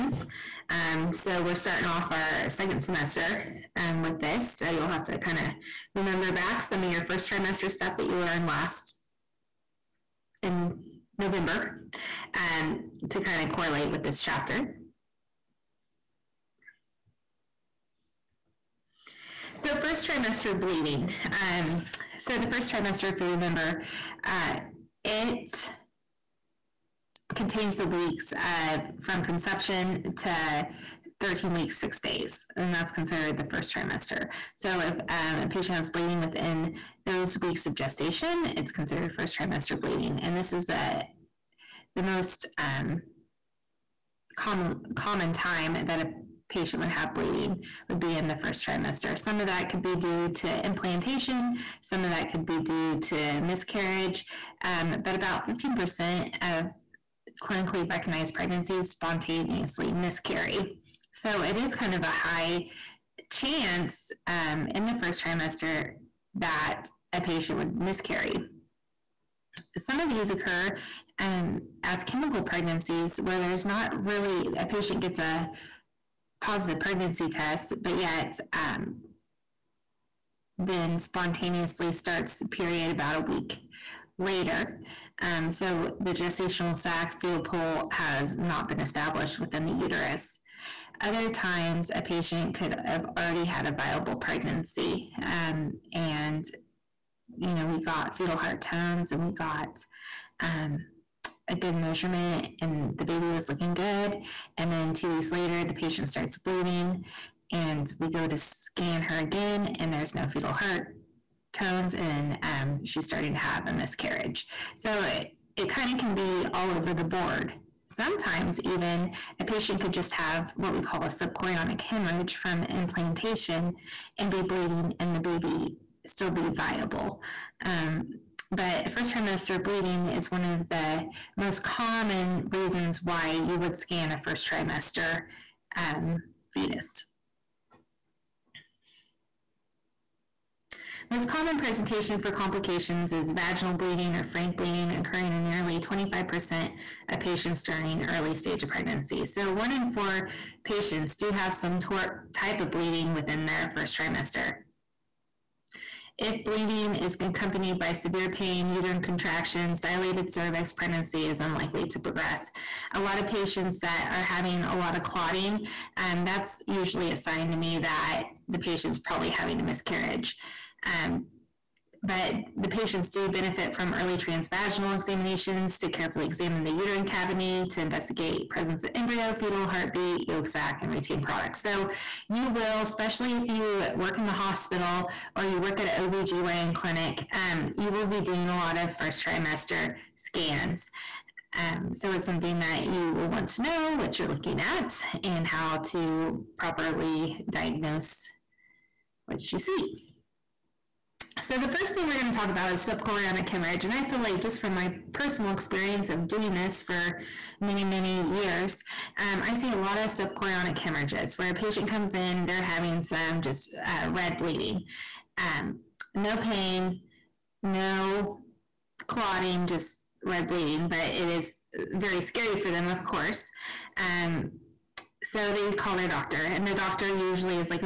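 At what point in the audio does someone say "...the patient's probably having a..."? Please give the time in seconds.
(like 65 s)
168 s.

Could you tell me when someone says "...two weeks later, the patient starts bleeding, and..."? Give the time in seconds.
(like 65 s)
104 s.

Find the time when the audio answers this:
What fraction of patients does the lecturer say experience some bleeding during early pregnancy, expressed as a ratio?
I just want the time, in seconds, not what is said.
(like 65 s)
149 s.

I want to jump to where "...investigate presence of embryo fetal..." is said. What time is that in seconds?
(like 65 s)
177 s.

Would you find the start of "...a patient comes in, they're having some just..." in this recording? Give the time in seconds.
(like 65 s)
211 s.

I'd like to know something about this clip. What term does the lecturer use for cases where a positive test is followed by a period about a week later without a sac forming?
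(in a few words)
chemical pregnancies.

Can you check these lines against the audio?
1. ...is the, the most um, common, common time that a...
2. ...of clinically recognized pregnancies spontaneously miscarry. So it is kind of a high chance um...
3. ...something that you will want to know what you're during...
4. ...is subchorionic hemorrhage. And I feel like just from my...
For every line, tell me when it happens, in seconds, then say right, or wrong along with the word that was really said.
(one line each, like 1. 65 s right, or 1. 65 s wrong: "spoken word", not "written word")
1. 40 s right
2. 56 s right
3. 192 s wrong: "looking", not "during"
4. 202 s right.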